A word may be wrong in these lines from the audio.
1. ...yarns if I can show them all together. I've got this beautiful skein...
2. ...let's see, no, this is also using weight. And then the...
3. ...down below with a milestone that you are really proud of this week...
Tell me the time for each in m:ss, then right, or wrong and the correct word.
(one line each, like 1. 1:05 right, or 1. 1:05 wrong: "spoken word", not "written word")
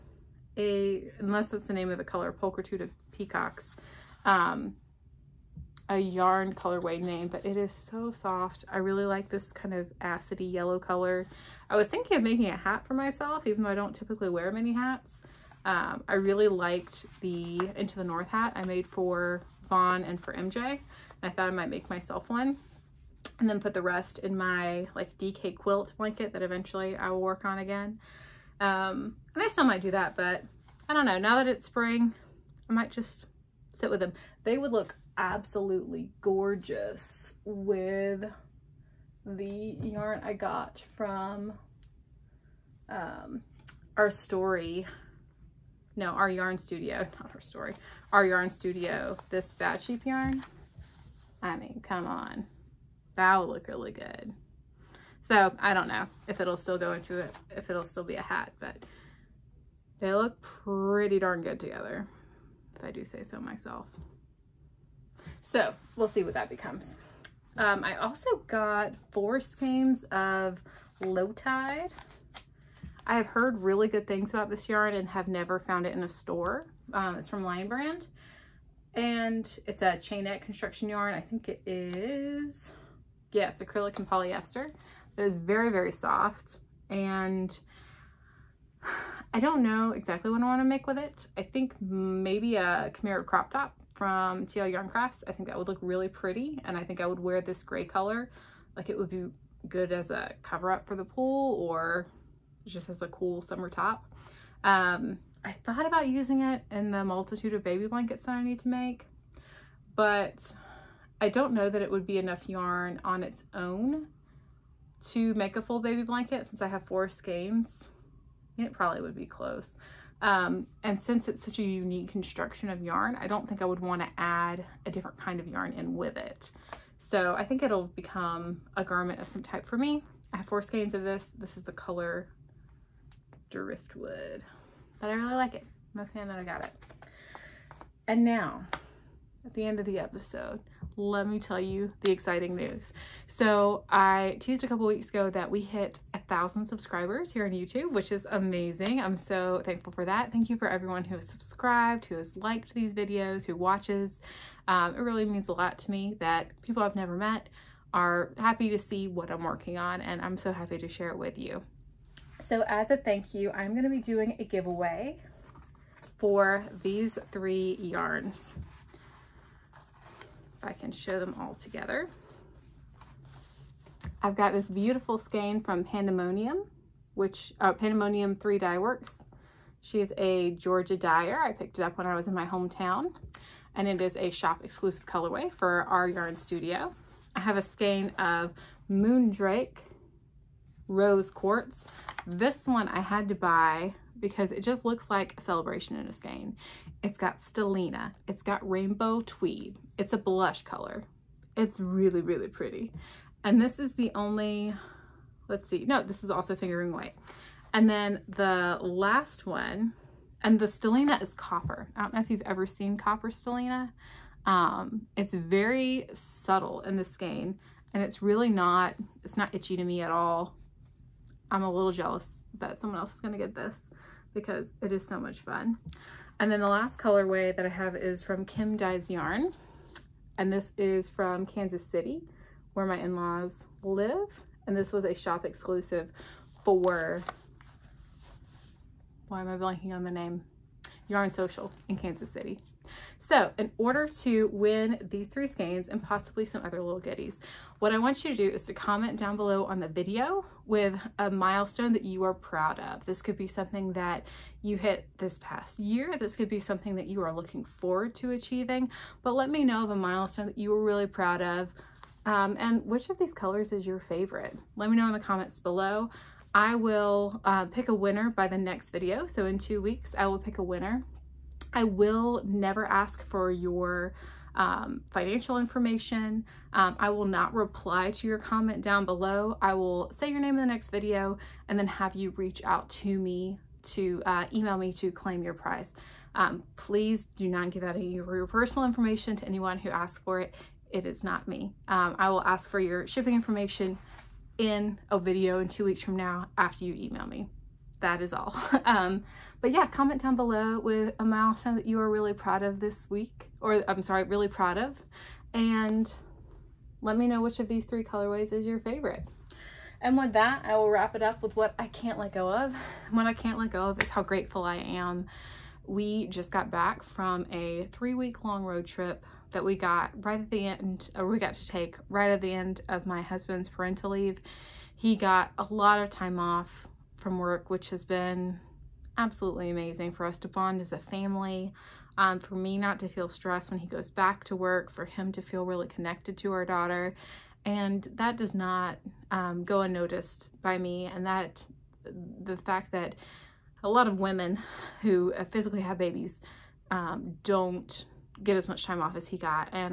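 1. 2:47 right
2. 3:25 wrong: "fingering", not "using"
3. 5:00 right.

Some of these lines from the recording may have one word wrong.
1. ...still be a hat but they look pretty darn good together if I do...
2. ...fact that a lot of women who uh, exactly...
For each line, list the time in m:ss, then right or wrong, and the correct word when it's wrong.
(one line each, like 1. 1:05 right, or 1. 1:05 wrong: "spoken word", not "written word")
1. 0:57 right
2. 5:42 wrong: "physically", not "exactly".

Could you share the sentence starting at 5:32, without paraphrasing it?
Um, for me not to feel stressed when he goes back to work, for him to feel really connected to our daughter.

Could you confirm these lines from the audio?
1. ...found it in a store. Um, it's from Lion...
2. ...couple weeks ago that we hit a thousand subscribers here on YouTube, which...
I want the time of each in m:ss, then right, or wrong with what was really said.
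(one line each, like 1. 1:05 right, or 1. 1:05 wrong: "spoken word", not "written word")
1. 1:15 right
2. 2:24 right.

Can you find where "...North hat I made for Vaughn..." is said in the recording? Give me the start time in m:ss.
0:18.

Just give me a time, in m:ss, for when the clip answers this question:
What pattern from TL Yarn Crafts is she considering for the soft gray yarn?
1:32.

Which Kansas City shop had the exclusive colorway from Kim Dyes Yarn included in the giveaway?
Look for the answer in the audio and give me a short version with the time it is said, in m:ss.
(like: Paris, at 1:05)
Yarn Social, at 4:01.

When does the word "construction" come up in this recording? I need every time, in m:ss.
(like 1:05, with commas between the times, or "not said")
1:20, 2:02.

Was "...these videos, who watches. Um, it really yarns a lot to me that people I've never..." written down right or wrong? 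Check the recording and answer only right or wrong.
wrong.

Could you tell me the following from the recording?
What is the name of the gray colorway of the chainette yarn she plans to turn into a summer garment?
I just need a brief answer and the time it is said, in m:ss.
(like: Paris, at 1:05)
Driftwood, at 2:13.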